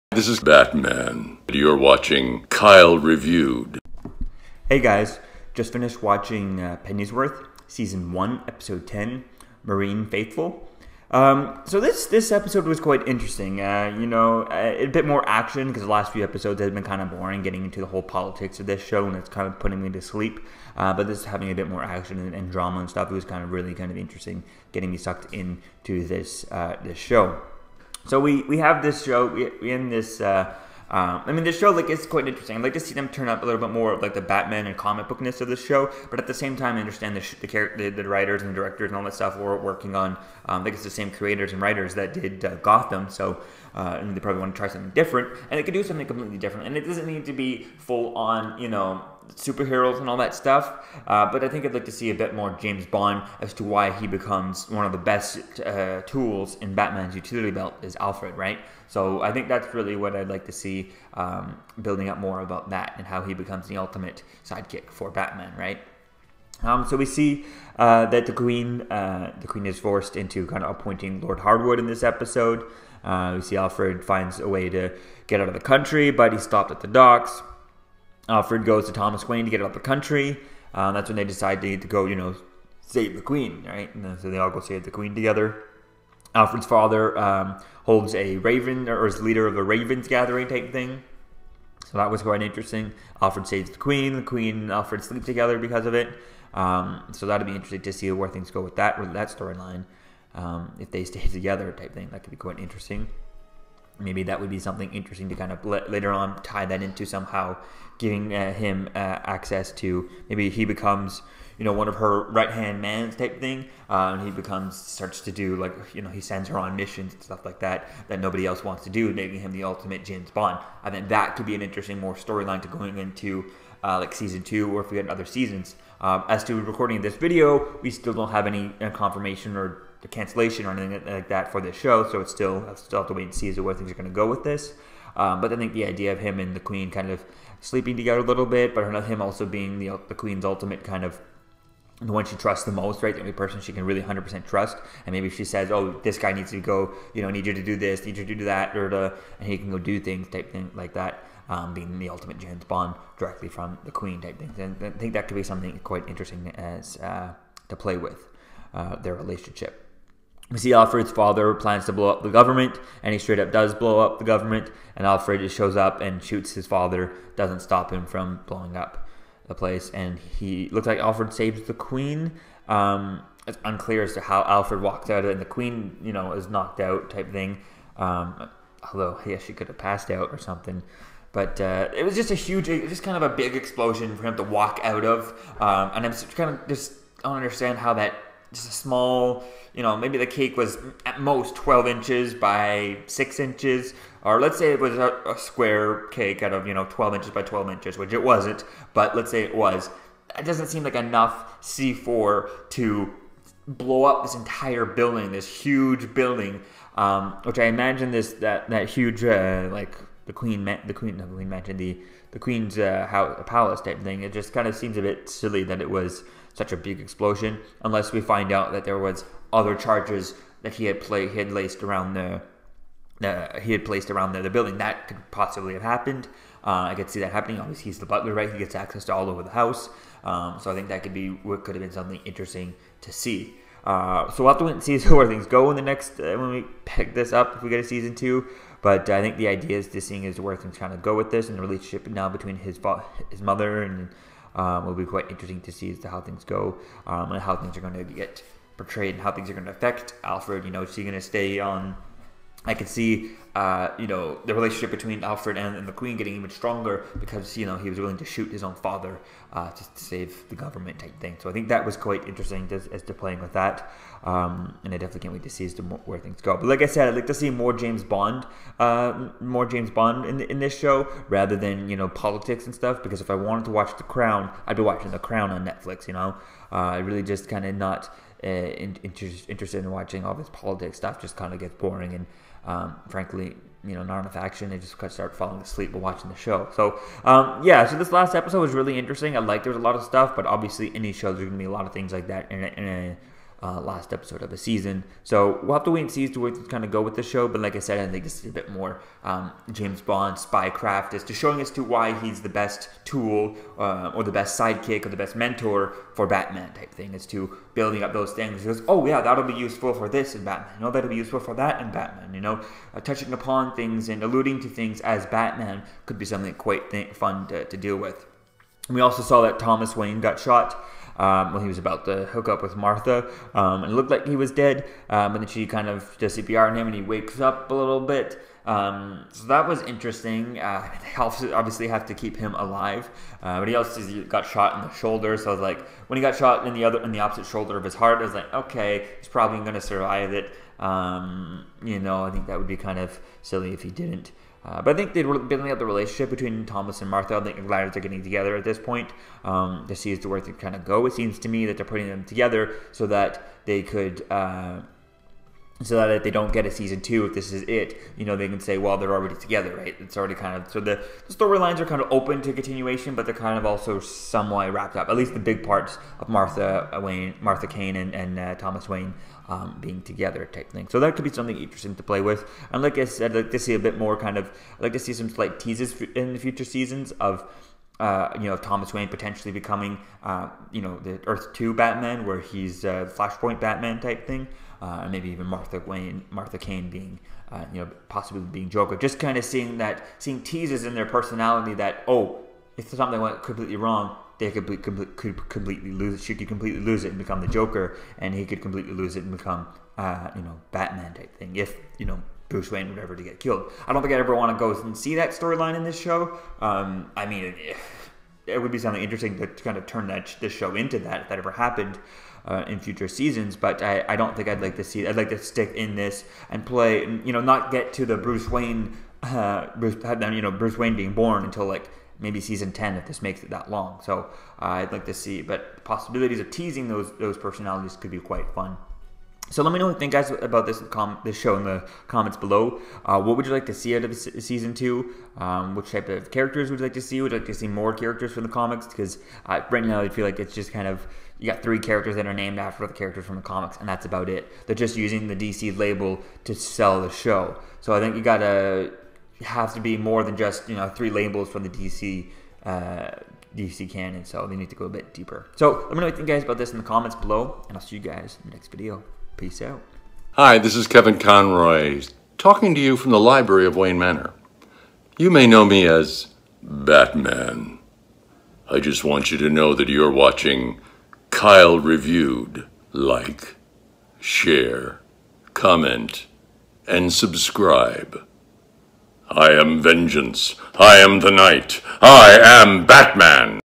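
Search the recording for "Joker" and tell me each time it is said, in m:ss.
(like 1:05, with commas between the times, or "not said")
6:28, 6:37.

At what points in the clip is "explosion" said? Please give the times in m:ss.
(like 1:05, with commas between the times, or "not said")
3:03, 3:36.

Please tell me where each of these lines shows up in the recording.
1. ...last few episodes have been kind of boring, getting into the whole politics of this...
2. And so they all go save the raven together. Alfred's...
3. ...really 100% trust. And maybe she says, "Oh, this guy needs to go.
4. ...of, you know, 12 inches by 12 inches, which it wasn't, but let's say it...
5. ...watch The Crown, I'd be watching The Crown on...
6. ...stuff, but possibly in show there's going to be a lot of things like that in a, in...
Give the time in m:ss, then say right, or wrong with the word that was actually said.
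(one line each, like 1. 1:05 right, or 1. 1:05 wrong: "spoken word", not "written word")
1. 0:15 right
2. 1:23 wrong: "queen", not "raven"
3. 2:23 right
4. 3:16 right
5. 4:33 right
6. 4:50 wrong: "obviously", not "possibly".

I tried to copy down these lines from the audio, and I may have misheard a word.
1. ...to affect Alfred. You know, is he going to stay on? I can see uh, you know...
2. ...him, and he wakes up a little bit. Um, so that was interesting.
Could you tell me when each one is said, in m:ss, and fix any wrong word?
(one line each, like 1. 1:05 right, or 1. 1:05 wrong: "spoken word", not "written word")
1. 4:09 right
2. 5:26 right.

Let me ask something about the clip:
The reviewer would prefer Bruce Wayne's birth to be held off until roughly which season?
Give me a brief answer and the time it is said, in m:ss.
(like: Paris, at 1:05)
10, at 7:02.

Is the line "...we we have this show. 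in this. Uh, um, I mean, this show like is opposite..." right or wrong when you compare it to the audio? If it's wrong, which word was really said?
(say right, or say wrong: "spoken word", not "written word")
wrong: "quite", not "opposite".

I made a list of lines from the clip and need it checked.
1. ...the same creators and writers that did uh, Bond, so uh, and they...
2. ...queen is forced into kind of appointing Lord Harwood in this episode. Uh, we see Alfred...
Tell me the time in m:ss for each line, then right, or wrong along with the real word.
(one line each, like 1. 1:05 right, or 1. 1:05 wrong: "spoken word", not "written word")
1. 0:40 wrong: "Gotham", not "Bond"
2. 1:09 right.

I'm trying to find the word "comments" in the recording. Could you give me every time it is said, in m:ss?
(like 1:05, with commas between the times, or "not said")
7:12, 7:36, 7:55.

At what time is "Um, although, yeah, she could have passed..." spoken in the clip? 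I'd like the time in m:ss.
2:57.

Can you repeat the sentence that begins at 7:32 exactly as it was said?
Uh, DC canon, so they need to go a bit deeper.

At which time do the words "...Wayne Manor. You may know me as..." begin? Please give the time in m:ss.
7:43.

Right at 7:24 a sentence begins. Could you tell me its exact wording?
They're just using the DC label to sell the show.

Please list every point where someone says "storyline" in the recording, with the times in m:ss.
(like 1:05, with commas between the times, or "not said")
1:39, 2:02, 6:01, 6:45.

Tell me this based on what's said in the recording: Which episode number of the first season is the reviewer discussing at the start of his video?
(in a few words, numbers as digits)
10.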